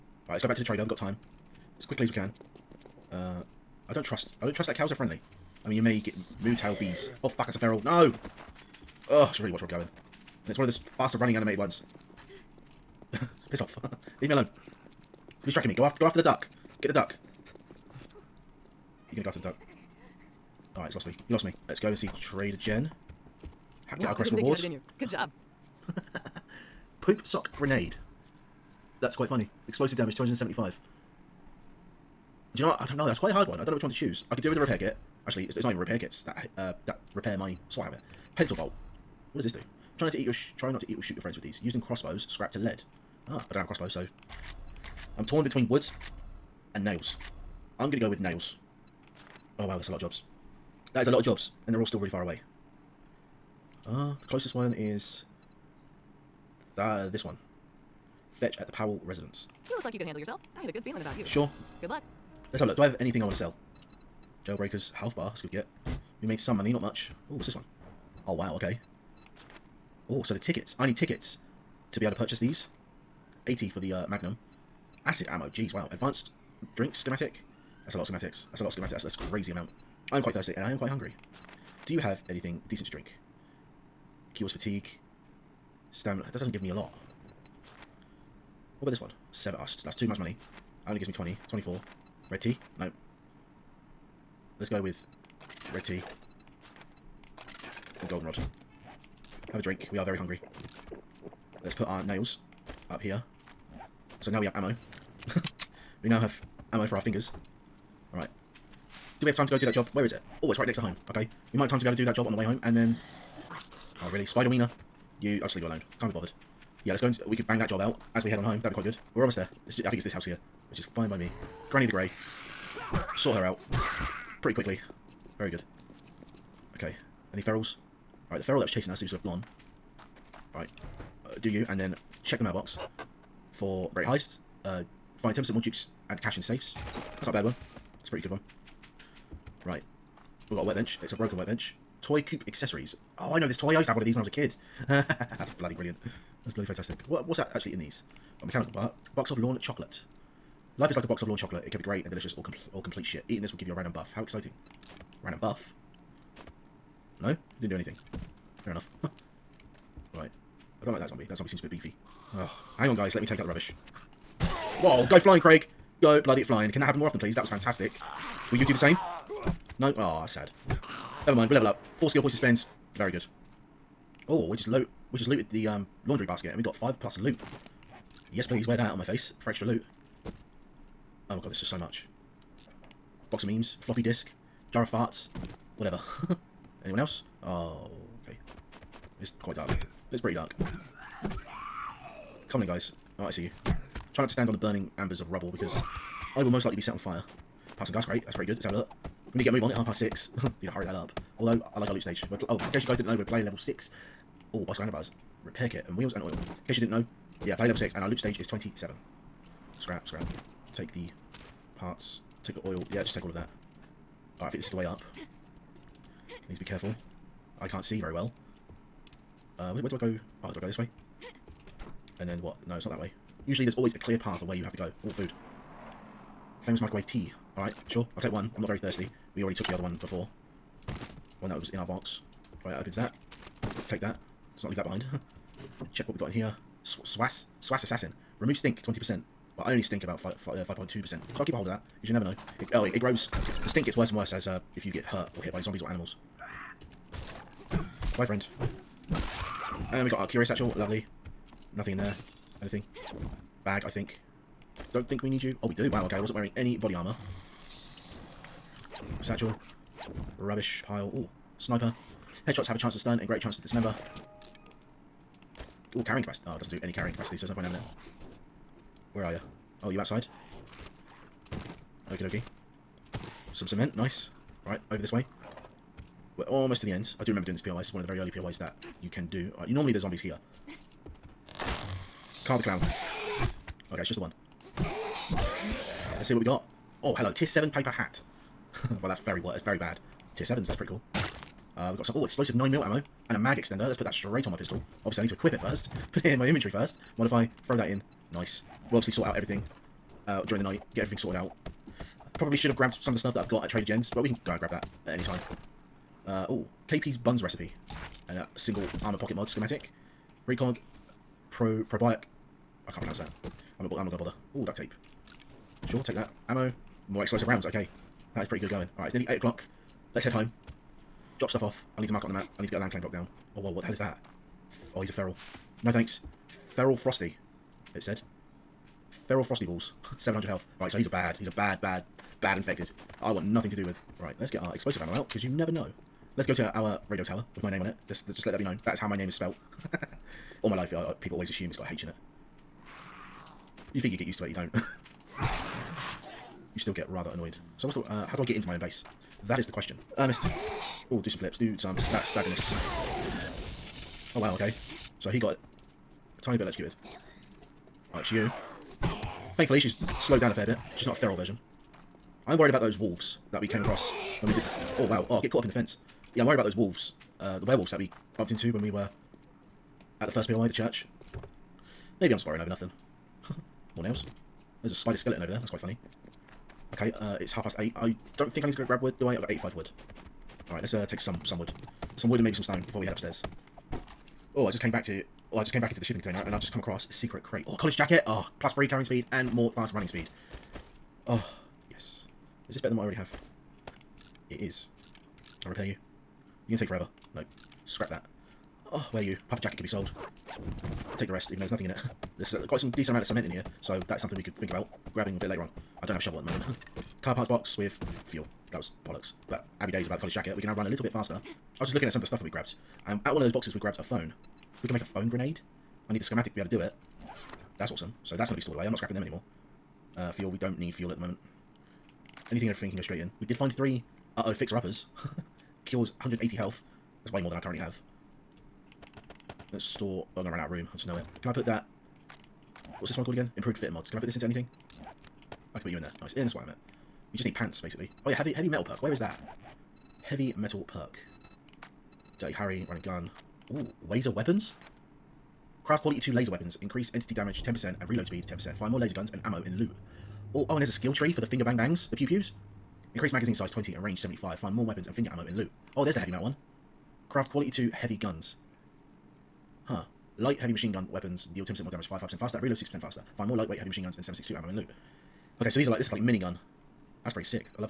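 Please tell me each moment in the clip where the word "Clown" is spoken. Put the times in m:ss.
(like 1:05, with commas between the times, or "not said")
4:42.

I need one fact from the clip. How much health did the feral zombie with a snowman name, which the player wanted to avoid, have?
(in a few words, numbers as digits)
700.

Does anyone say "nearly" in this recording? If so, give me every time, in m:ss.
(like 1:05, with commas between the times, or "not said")
5:19.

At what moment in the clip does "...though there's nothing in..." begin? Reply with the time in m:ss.
6:41.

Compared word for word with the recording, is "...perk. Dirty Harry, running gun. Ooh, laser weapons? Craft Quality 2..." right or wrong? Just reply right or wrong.
right.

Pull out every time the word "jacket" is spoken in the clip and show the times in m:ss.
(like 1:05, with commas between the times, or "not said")
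6:27, 6:39, 6:50.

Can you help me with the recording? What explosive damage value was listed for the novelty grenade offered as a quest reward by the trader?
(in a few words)
275.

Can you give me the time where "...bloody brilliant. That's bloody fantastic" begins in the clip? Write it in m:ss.
2:25.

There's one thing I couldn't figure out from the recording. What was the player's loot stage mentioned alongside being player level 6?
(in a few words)
27.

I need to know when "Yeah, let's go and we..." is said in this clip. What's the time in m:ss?
1:56.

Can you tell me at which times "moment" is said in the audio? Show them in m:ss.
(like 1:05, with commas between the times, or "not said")
6:46, 7:01.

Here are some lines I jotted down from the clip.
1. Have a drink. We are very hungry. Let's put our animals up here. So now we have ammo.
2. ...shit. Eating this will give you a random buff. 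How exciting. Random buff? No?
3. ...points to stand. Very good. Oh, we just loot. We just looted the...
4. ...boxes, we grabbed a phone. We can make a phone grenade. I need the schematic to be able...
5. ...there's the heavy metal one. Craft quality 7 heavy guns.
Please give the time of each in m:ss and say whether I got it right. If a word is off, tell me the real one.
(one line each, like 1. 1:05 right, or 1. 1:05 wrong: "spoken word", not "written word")
1. 1:39 wrong: "nails", not "animals"
2. 2:33 right
3. 2:52 wrong: "spend", not "stand"
4. 6:53 right
5. 7:36 wrong: "2", not "7".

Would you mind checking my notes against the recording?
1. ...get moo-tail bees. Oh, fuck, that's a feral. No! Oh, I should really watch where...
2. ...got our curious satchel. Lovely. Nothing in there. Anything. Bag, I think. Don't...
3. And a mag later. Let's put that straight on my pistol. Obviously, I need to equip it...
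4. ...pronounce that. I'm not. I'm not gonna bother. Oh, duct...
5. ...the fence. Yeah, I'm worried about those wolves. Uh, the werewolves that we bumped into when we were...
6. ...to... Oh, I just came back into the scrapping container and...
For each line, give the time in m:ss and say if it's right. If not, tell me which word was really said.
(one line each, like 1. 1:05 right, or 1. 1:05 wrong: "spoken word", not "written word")
1. 0:05 right
2. 4:10 right
3. 4:53 wrong: "extender", not "later"
4. 5:13 right
5. 6:05 right
6. 6:25 wrong: "shipping", not "scrapping".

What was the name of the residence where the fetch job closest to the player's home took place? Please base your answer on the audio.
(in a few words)
Powell residence.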